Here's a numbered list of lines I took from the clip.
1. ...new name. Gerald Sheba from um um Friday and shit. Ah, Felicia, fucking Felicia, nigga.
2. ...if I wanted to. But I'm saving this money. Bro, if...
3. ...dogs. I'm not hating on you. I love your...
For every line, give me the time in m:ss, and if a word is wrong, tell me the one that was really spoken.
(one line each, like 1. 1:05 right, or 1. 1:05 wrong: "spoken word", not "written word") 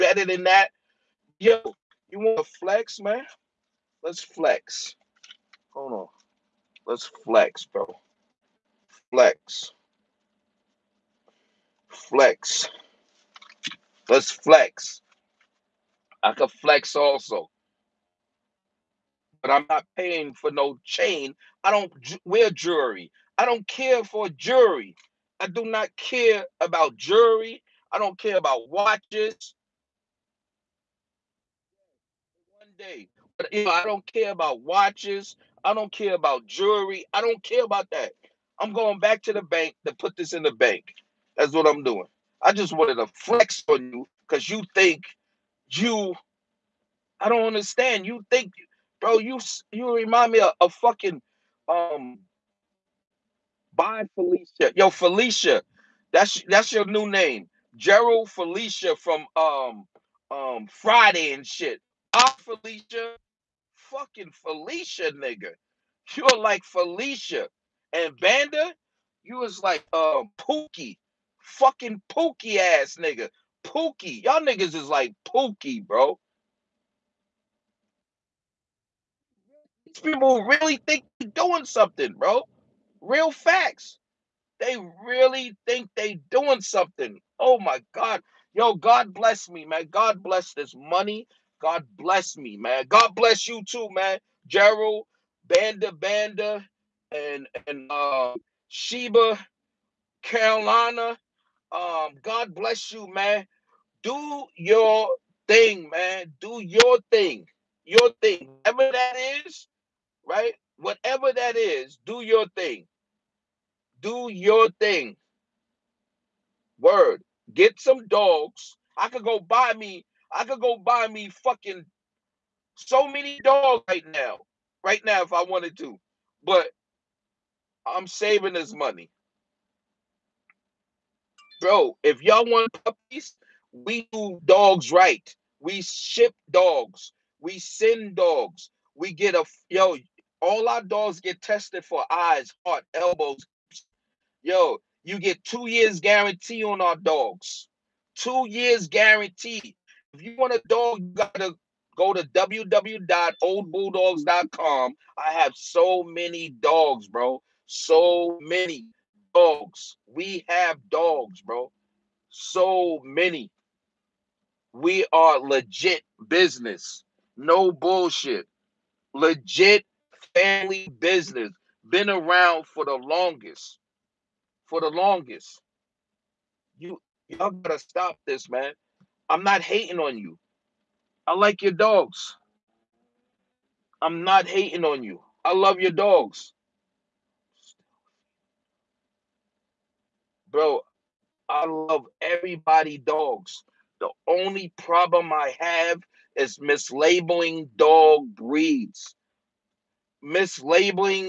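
1. 0:56 wrong: "Felicia", not "Sheba"
2. 2:05 right
3. 3:01 right.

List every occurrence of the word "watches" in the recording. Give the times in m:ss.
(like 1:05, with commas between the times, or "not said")
0:28, 0:34.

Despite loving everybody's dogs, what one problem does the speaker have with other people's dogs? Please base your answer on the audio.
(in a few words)
Mislabeling dog breeds.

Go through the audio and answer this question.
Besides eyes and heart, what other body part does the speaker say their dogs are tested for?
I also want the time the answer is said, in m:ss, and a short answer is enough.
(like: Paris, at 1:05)
Elbows, at 2:22.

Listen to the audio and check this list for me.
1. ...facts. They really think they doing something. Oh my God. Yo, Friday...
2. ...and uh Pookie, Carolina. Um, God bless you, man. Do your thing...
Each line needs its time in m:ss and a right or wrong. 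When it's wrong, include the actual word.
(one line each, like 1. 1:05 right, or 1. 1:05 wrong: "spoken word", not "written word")
1. 1:23 wrong: "God", not "Friday"
2. 1:37 wrong: "Sheba", not "Pookie".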